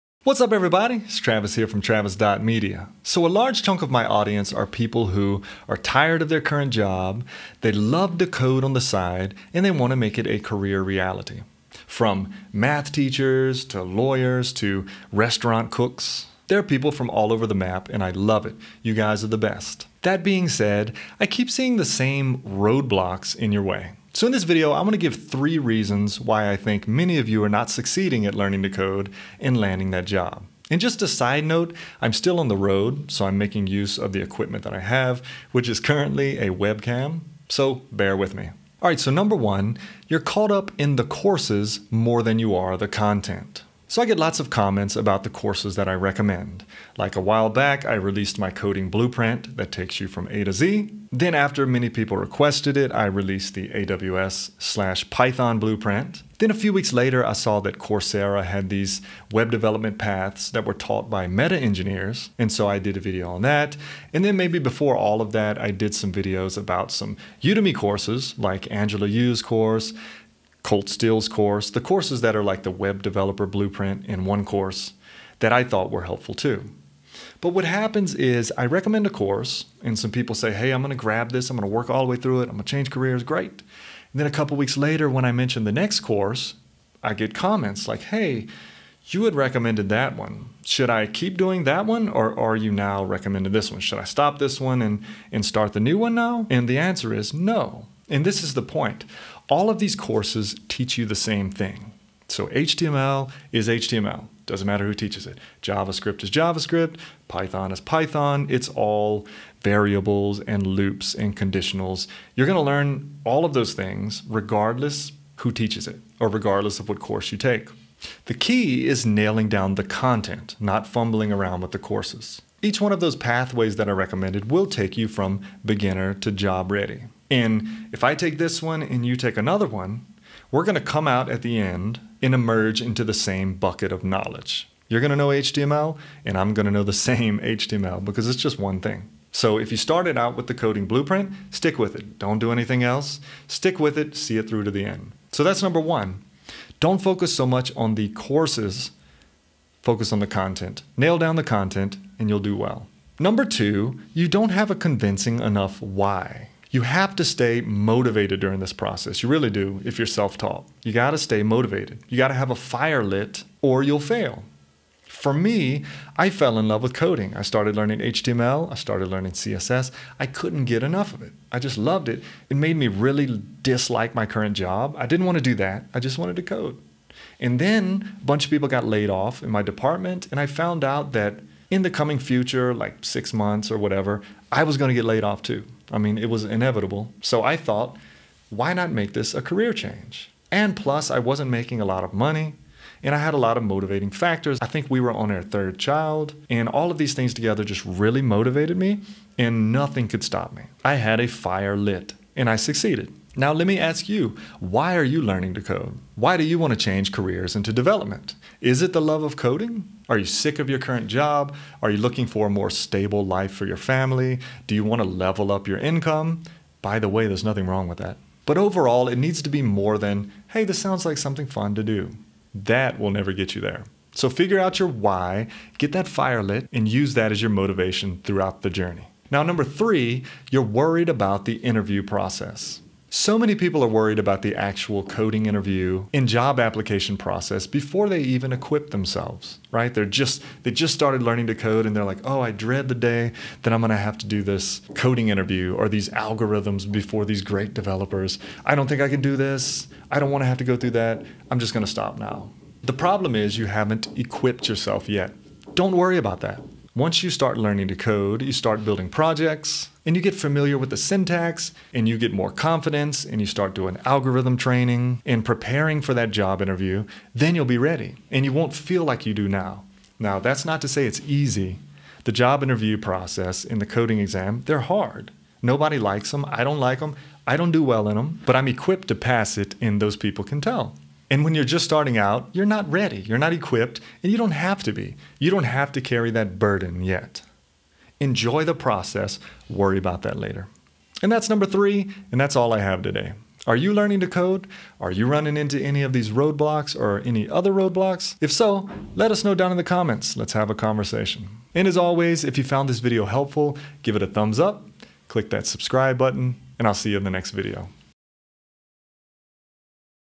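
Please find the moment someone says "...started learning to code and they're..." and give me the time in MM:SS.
04:00.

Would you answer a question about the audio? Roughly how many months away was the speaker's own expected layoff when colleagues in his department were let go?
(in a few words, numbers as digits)
6.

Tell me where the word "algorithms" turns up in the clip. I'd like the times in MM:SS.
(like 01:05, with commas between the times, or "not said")
04:06, 04:24.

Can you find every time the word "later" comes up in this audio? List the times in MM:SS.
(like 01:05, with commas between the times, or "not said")
00:56, 01:24, 04:50.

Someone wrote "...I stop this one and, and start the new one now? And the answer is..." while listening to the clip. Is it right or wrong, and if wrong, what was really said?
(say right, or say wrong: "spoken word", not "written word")
right.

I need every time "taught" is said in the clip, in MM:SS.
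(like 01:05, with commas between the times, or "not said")
01:00, 02:40.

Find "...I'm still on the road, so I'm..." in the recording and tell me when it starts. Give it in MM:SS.
00:32.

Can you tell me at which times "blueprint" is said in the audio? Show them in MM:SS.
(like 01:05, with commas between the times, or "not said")
00:48, 00:55, 01:13, 02:20.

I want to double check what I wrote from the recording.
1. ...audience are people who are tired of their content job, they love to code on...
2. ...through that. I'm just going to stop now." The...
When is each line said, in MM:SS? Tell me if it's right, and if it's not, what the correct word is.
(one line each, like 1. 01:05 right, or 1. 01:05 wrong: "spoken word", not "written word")
1. 00:04 wrong: "current", not "content"
2. 04:10 right.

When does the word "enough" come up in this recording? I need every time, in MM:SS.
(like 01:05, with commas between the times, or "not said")
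02:35, 02:50.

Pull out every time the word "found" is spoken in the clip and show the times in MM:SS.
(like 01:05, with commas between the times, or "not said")
03:00, 05:02.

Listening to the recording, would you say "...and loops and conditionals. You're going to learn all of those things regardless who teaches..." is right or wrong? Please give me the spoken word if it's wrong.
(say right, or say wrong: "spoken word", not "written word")
right.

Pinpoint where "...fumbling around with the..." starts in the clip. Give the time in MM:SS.
02:00.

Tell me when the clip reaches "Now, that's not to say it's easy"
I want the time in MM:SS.
04:30.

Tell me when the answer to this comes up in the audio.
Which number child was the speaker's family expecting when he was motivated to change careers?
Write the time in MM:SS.
03:15.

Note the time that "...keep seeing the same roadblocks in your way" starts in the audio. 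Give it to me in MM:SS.
00:21.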